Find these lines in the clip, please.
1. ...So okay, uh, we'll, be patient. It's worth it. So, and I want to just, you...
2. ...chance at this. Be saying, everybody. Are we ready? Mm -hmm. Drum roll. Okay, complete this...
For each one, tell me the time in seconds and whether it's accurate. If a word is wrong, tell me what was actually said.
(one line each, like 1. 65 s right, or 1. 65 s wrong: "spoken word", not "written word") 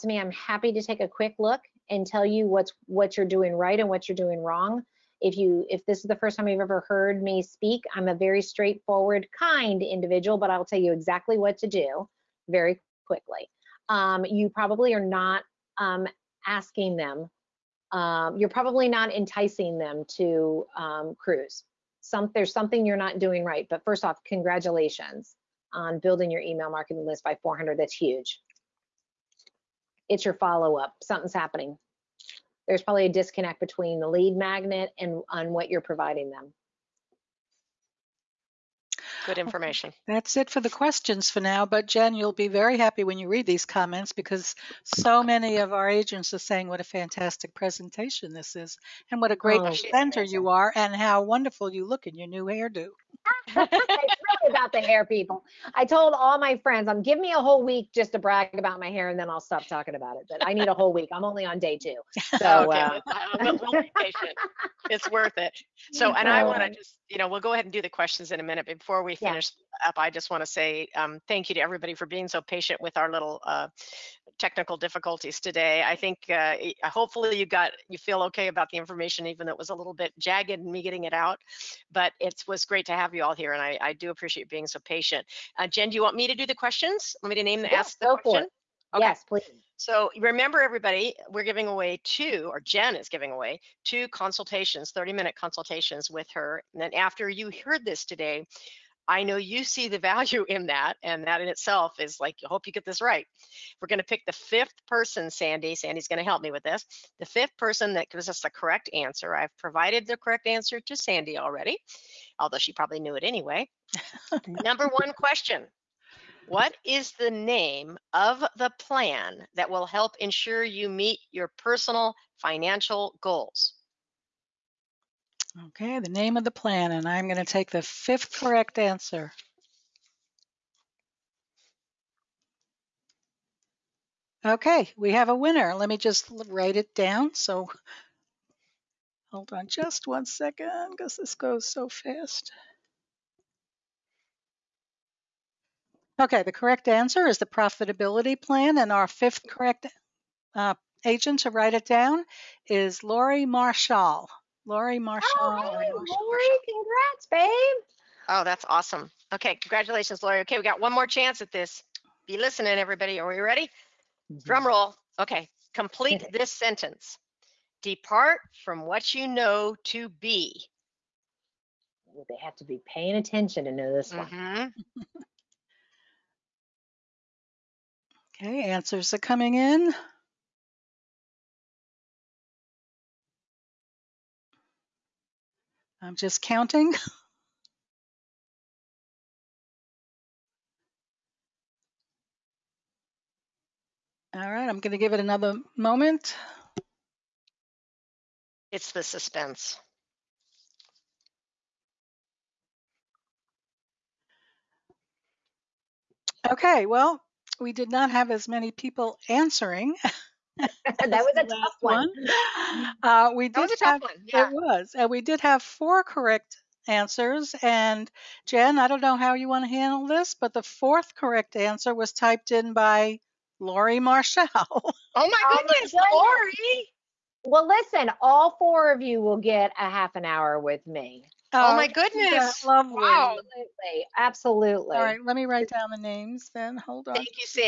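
1. 62 s right
2. 161 s wrong: "listening", not "saying".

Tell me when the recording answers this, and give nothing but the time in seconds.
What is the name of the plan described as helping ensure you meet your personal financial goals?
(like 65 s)
147 s.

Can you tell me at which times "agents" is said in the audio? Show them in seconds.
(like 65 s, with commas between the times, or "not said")
45 s, 151 s.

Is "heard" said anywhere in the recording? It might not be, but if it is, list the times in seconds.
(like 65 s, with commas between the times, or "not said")
6 s, 97 s.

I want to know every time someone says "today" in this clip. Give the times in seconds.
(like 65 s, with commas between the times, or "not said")
75 s, 98 s.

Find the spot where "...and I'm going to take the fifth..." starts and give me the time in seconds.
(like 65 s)
126 s.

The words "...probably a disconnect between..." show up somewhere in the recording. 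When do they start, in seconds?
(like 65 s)
32 s.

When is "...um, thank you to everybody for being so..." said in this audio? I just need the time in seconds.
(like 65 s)
70 s.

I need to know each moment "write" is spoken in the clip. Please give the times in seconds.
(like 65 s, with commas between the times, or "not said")
136 s, 151 s, 235 s.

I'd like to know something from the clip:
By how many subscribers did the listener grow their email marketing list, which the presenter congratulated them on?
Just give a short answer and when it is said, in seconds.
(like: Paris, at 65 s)
400, at 27 s.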